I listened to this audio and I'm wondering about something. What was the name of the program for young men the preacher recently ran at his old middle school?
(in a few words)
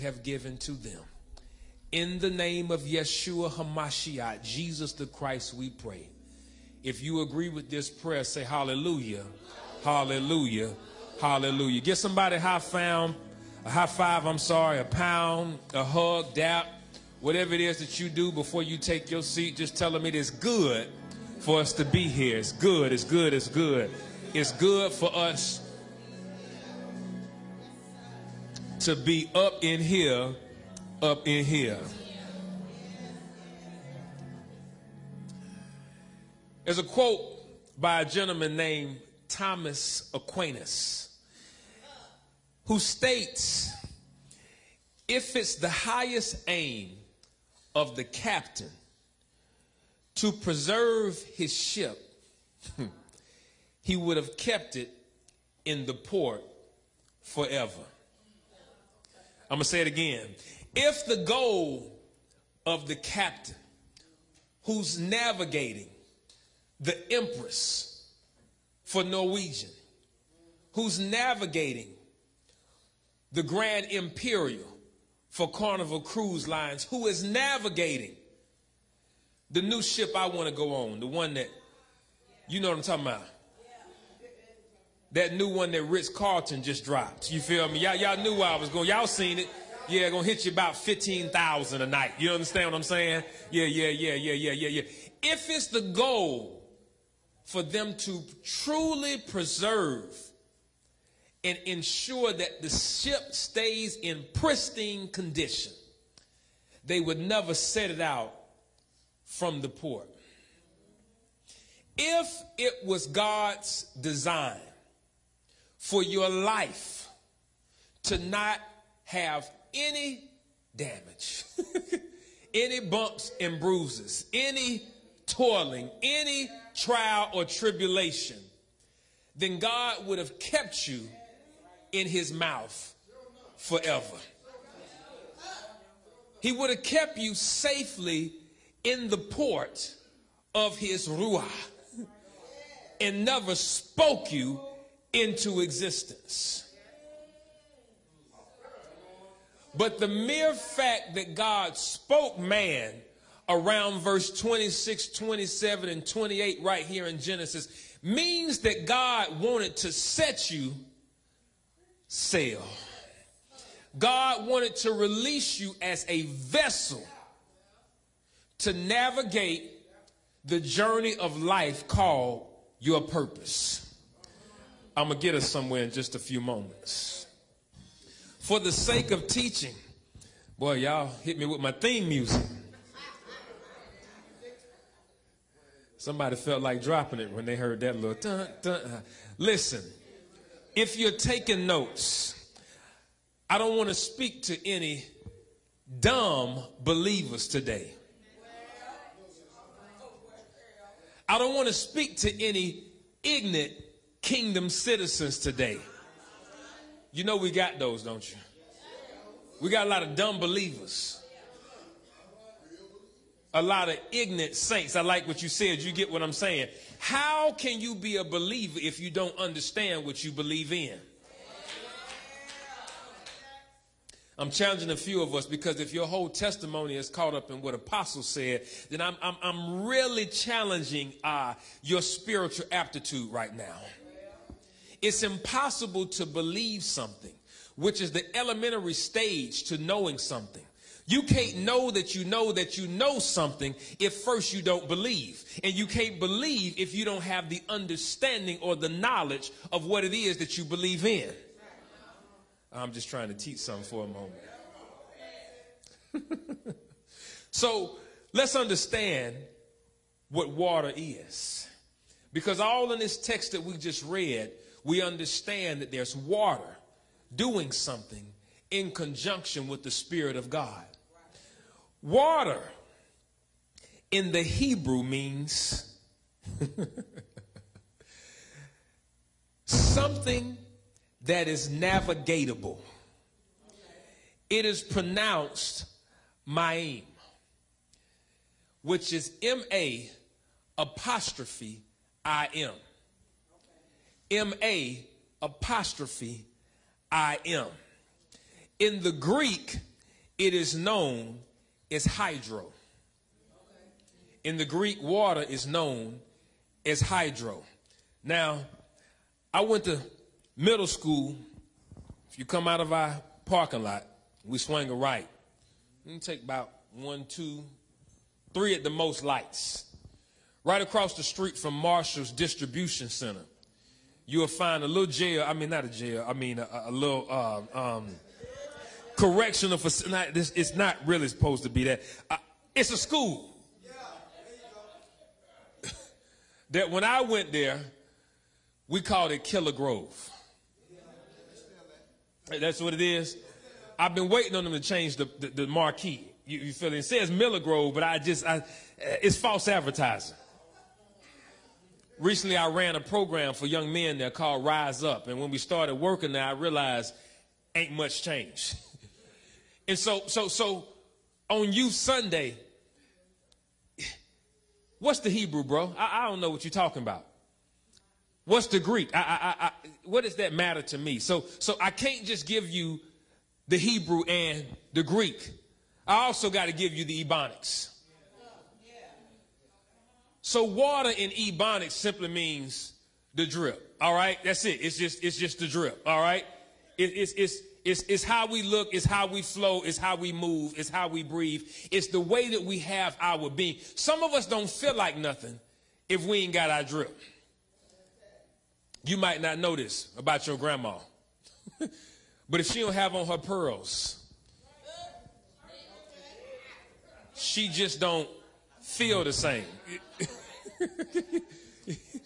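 Rise Up.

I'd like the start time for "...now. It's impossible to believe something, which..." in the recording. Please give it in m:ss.
3:53.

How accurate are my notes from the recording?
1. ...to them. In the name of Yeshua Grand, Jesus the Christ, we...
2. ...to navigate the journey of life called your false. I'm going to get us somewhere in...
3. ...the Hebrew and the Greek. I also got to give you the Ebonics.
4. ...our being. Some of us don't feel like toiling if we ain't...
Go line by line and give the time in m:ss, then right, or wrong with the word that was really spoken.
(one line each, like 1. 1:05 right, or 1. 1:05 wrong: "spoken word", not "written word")
1. 0:00 wrong: "HaMashiach", not "Grand"
2. 2:48 wrong: "purpose", not "false"
3. 6:13 right
4. 6:33 wrong: "nothing", not "toiling".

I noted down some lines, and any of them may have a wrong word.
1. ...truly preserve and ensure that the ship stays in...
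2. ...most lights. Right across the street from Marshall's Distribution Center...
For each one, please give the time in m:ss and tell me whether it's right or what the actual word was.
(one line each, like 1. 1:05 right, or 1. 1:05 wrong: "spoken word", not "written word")
1. 1:38 right
2. 5:18 right.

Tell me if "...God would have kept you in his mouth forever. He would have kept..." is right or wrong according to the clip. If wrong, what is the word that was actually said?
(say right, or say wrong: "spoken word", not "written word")
right.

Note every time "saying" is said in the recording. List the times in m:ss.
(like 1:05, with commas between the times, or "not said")
1:32, 3:36.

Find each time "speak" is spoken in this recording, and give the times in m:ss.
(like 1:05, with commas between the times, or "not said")
3:13, 3:21.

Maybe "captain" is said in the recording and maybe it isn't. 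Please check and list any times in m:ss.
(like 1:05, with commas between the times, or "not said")
0:48, 1:02.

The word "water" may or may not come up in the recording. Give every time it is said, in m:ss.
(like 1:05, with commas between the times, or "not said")
4:20, 4:26, 4:32, 5:05, 6:20.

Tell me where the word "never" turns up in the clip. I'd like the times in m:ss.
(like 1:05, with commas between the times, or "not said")
1:47, 2:23.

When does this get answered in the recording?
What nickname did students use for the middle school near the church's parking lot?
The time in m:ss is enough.
5:39.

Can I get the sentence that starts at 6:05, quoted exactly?
I, I don't know what you're talking about.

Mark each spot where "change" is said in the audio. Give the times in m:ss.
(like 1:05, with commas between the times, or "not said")
5:44, 5:58.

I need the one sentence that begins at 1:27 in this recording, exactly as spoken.
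Y'all, y'all knew where I was going.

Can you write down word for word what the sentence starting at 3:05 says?
Somebody felt like dropping it when they heard that little dun dun.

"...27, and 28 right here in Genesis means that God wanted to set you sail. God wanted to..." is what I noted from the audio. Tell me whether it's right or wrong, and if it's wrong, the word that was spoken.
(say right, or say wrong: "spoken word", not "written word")
right.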